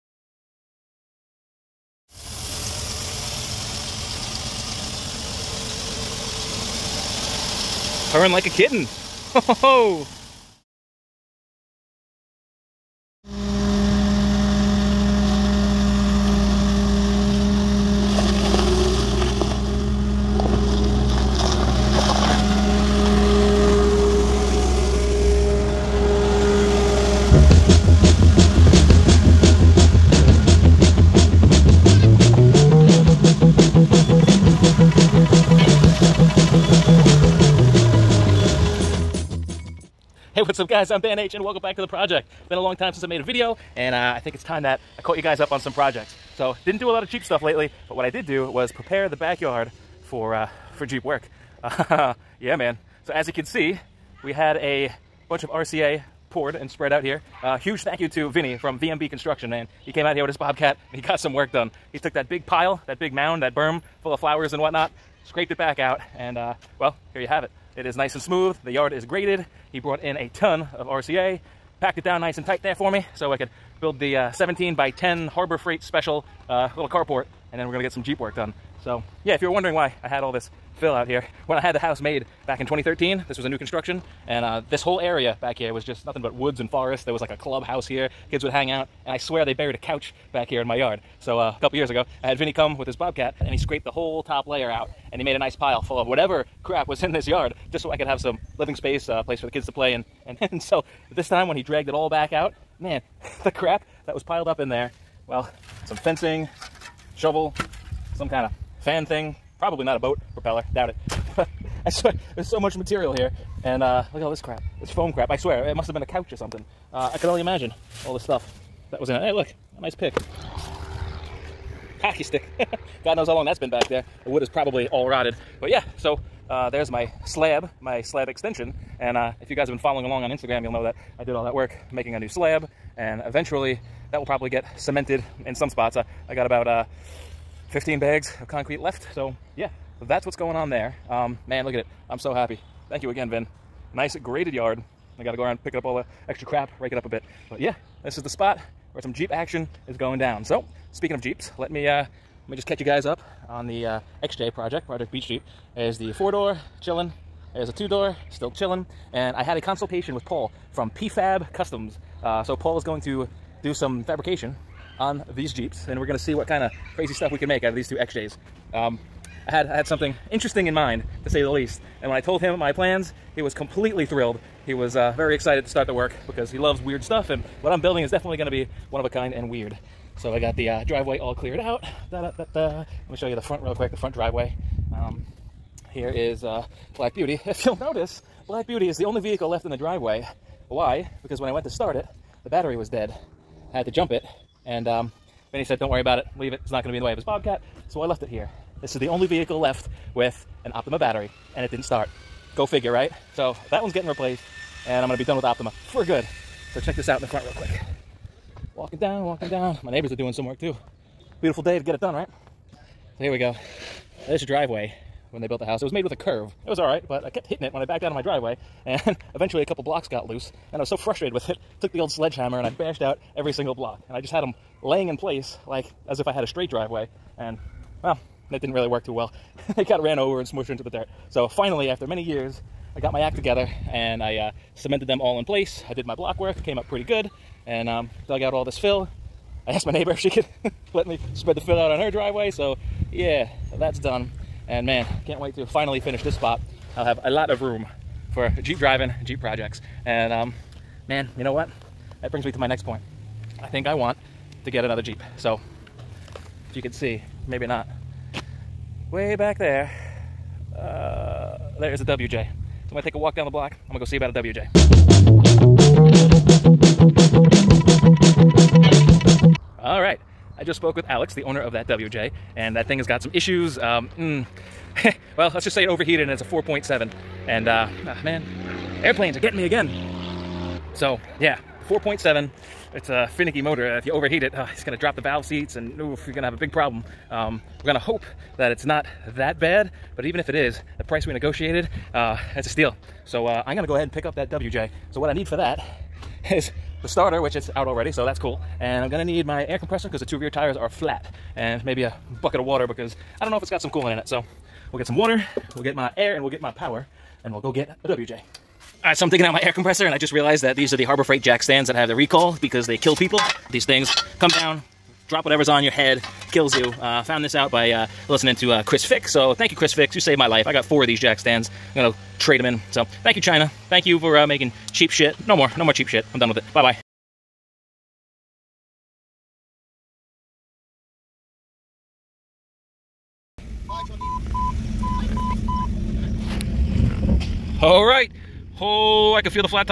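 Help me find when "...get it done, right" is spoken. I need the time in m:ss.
3:31.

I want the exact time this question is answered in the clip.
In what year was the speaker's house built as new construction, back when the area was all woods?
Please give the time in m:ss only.
1:22.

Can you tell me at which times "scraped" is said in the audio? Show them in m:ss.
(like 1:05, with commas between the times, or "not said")
1:05, 1:33.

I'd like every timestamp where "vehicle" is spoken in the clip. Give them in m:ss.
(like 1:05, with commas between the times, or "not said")
3:09, 3:19.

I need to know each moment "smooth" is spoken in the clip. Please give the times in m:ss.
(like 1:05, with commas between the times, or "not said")
1:08.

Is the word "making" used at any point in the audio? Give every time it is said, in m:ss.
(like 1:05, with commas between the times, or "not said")
2:11, 5:24.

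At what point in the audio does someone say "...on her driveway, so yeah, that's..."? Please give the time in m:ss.
4:01.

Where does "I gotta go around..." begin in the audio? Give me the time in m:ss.
2:25.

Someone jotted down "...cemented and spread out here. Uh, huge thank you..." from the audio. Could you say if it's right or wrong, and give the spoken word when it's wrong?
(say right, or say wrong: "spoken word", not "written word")
wrong: "poured", not "cemented".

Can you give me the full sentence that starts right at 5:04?
So we'll get some water, we'll get my air, and we'll get my power, and we'll go get a WJ.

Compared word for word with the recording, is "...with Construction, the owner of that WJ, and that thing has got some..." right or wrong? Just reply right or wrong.
wrong.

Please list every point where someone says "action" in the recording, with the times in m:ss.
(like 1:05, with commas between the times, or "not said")
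2:29.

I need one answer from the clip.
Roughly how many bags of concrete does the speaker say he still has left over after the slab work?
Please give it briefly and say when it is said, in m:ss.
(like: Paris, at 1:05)
15, at 2:17.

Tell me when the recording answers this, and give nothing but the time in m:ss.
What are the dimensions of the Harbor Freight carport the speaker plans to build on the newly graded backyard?
1:14.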